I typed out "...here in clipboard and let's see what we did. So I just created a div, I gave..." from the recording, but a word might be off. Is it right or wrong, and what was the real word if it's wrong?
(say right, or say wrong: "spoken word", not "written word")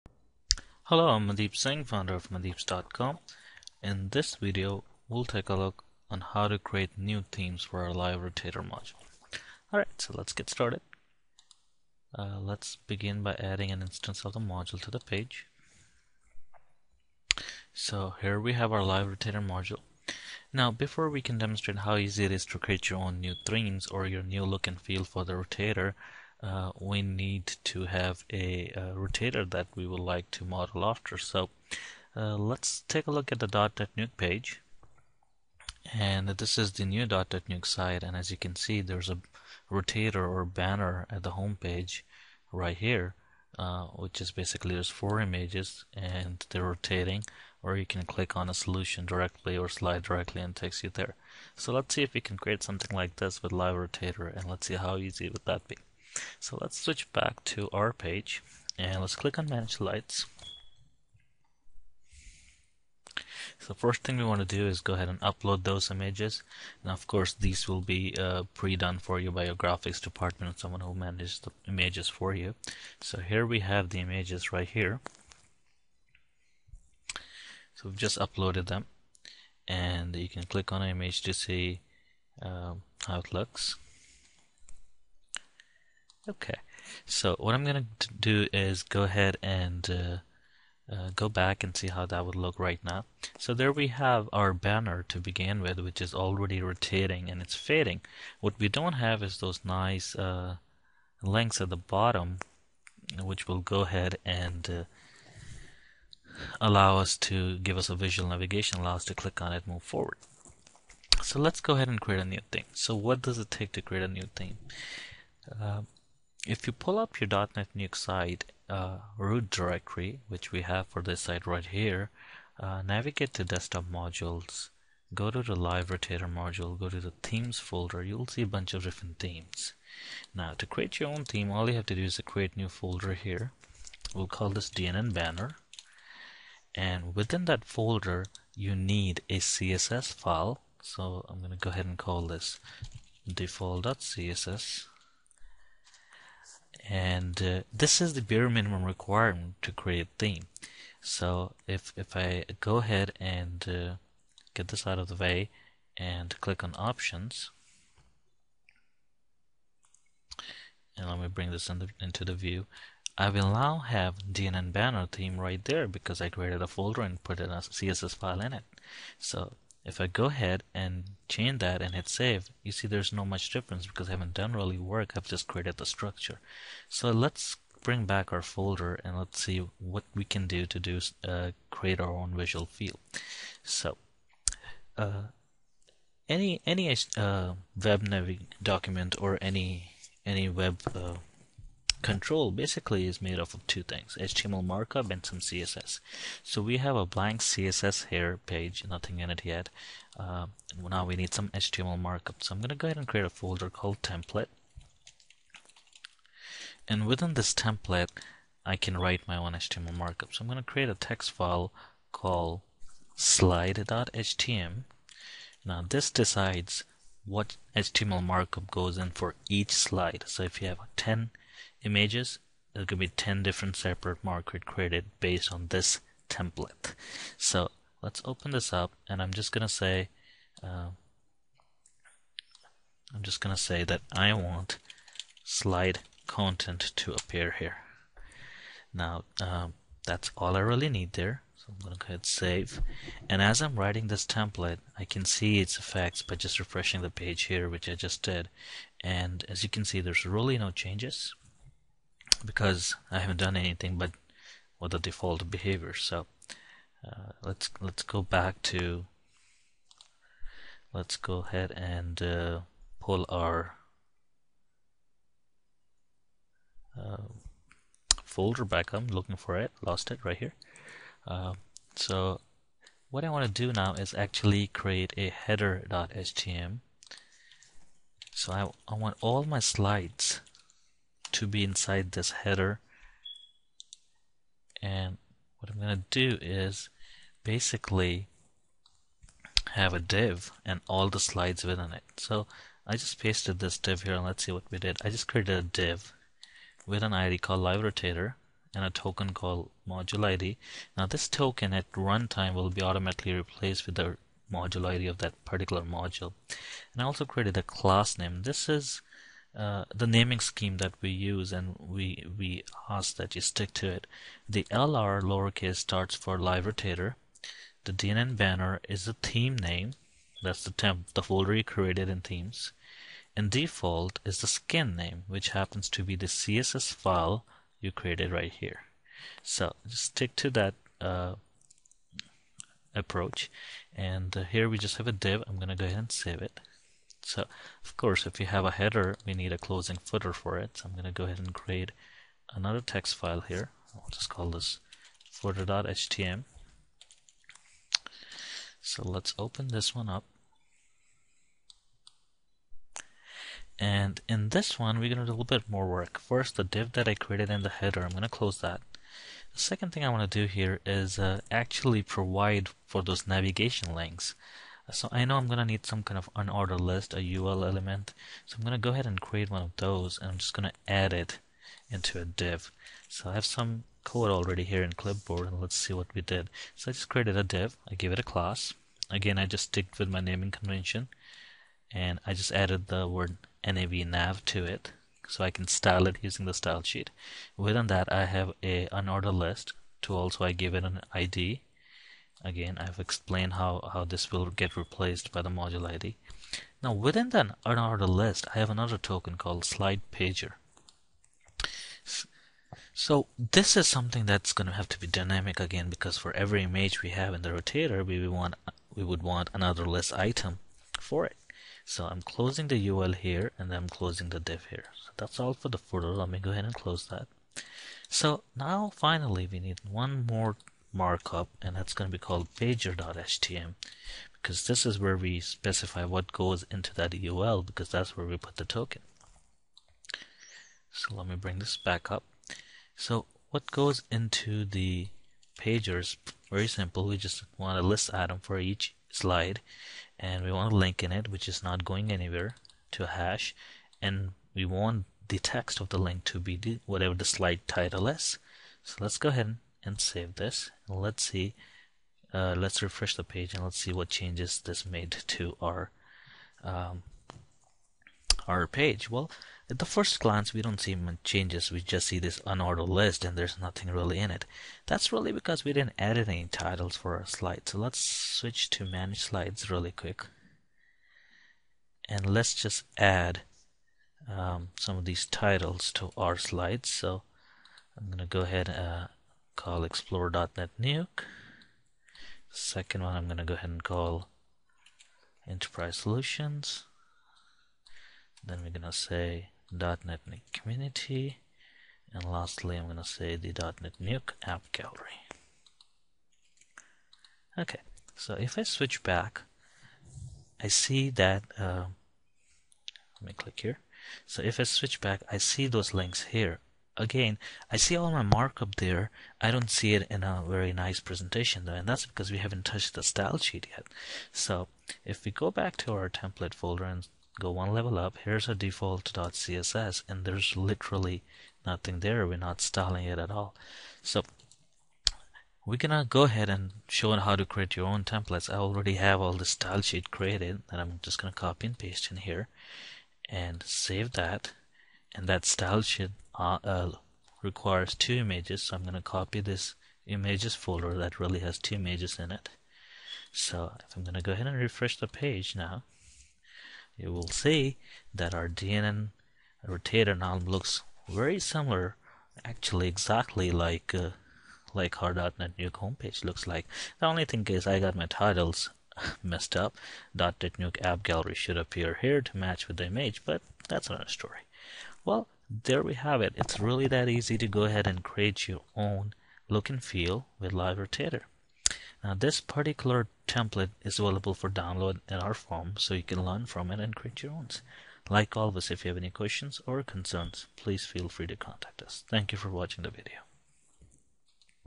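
right.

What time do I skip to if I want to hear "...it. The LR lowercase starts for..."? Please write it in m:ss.
5:13.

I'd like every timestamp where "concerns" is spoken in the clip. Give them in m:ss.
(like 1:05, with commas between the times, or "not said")
9:39.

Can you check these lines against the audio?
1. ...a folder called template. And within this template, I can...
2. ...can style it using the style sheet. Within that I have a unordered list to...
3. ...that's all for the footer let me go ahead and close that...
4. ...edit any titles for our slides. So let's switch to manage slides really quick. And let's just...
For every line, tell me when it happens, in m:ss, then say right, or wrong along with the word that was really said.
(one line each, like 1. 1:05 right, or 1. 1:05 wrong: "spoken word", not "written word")
1. 3:23 right
2. 6:25 right
3. 6:55 right
4. 7:45 right.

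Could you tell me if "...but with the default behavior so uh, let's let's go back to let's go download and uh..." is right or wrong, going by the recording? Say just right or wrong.
wrong.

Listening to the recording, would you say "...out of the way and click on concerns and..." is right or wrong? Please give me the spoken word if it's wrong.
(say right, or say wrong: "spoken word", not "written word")
wrong: "options", not "concerns".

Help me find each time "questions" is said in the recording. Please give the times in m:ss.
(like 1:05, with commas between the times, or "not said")
9:39.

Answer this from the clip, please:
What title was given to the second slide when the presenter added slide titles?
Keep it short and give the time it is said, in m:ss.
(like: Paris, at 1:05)
Enterprise solutions, at 8:05.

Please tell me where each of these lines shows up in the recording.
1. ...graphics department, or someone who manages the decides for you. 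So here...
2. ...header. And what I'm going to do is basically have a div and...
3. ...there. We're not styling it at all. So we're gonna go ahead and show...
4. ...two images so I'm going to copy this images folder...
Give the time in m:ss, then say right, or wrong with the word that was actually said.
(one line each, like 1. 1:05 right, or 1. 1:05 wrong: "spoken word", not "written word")
1. 1:09 wrong: "images", not "decides"
2. 4:42 right
3. 8:42 right
4. 8:57 right.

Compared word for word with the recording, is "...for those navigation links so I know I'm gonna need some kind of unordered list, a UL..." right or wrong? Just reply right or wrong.
right.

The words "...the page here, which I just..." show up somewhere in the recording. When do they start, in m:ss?
4:07.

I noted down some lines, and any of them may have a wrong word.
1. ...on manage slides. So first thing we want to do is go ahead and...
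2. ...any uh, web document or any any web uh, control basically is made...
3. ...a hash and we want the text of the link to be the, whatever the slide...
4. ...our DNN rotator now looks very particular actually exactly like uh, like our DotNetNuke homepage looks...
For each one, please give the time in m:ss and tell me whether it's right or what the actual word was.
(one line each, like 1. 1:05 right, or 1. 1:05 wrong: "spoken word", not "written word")
1. 0:59 right
2. 3:06 right
3. 7:23 right
4. 9:08 wrong: "similar", not "particular".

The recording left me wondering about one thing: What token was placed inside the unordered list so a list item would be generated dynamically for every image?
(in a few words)
slide pager.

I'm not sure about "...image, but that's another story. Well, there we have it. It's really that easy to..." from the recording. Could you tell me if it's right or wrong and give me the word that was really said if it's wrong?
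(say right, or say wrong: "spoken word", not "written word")
right.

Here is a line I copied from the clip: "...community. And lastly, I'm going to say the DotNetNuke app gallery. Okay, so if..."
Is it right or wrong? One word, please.
right.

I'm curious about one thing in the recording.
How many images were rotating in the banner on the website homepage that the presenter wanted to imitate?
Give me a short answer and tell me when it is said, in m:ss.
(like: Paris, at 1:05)
4, at 0:44.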